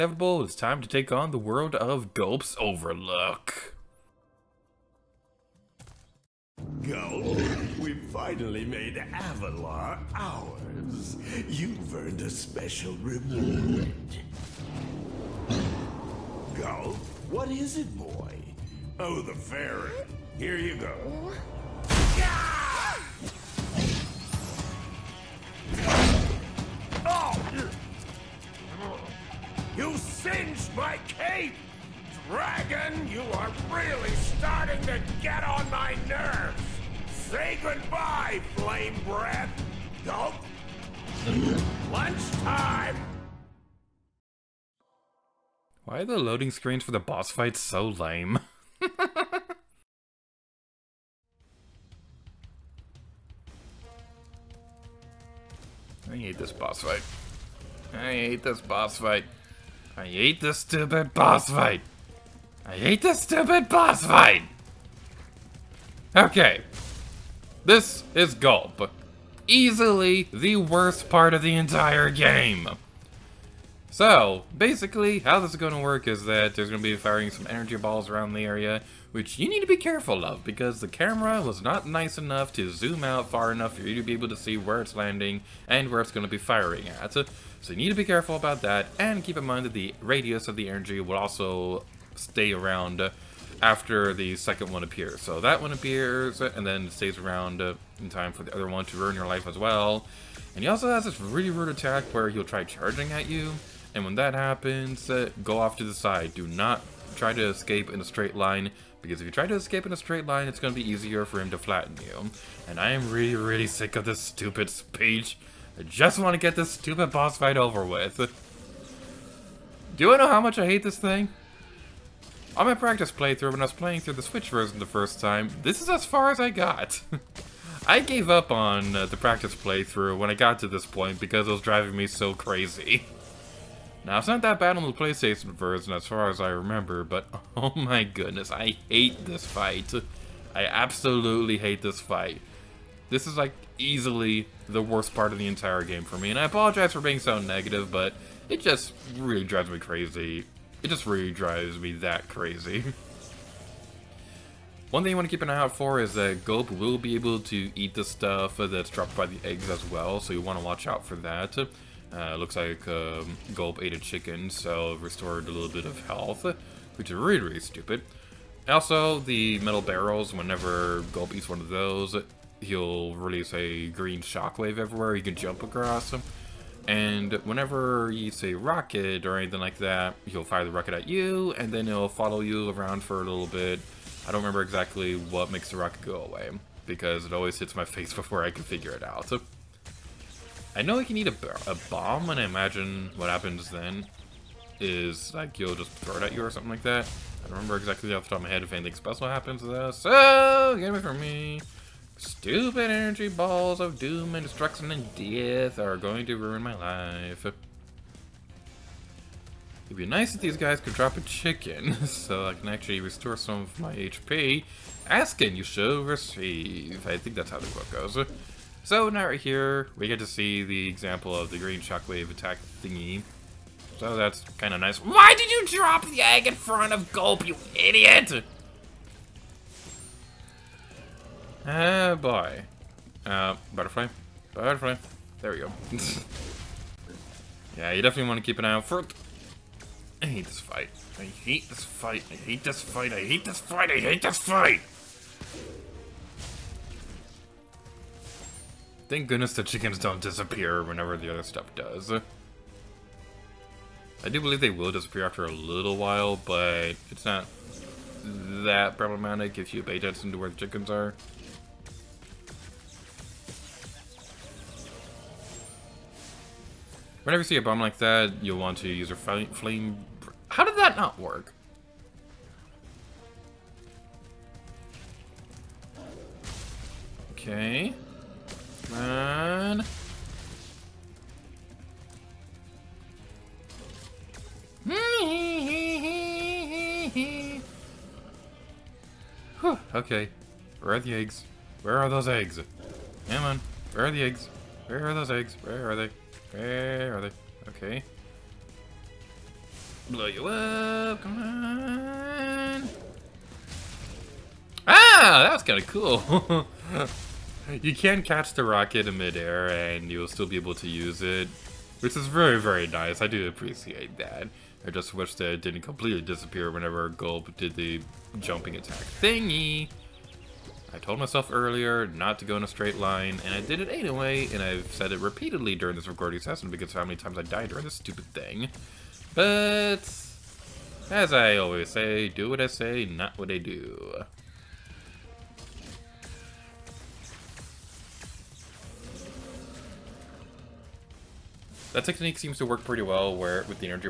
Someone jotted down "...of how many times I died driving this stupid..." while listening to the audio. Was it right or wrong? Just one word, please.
wrong.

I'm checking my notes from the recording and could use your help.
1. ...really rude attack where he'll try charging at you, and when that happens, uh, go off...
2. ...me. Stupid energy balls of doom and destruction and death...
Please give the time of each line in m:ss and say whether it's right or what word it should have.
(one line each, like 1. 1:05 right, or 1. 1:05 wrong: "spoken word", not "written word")
1. 1:41 right
2. 3:21 right.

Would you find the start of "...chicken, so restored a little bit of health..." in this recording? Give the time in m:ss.
2:43.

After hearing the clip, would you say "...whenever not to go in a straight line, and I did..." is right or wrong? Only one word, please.
wrong.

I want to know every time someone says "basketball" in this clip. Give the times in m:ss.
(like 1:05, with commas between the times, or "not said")
not said.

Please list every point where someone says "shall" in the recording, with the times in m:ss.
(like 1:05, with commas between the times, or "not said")
3:35.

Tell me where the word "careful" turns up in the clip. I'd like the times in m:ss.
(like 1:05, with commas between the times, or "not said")
1:19, 1:28.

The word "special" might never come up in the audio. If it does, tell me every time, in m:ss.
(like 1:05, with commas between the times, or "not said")
0:12, 3:18.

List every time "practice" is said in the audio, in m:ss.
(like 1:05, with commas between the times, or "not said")
2:02, 2:09.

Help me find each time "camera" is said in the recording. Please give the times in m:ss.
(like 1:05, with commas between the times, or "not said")
1:20.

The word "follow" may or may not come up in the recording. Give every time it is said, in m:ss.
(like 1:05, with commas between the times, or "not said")
3:02.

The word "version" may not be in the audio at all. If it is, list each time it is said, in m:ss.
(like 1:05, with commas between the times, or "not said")
2:04, 2:15.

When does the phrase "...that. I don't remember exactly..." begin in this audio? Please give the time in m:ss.
3:16.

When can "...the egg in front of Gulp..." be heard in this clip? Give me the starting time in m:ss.
3:46.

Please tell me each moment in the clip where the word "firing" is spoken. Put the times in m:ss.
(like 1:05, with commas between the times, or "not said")
1:16, 1:26.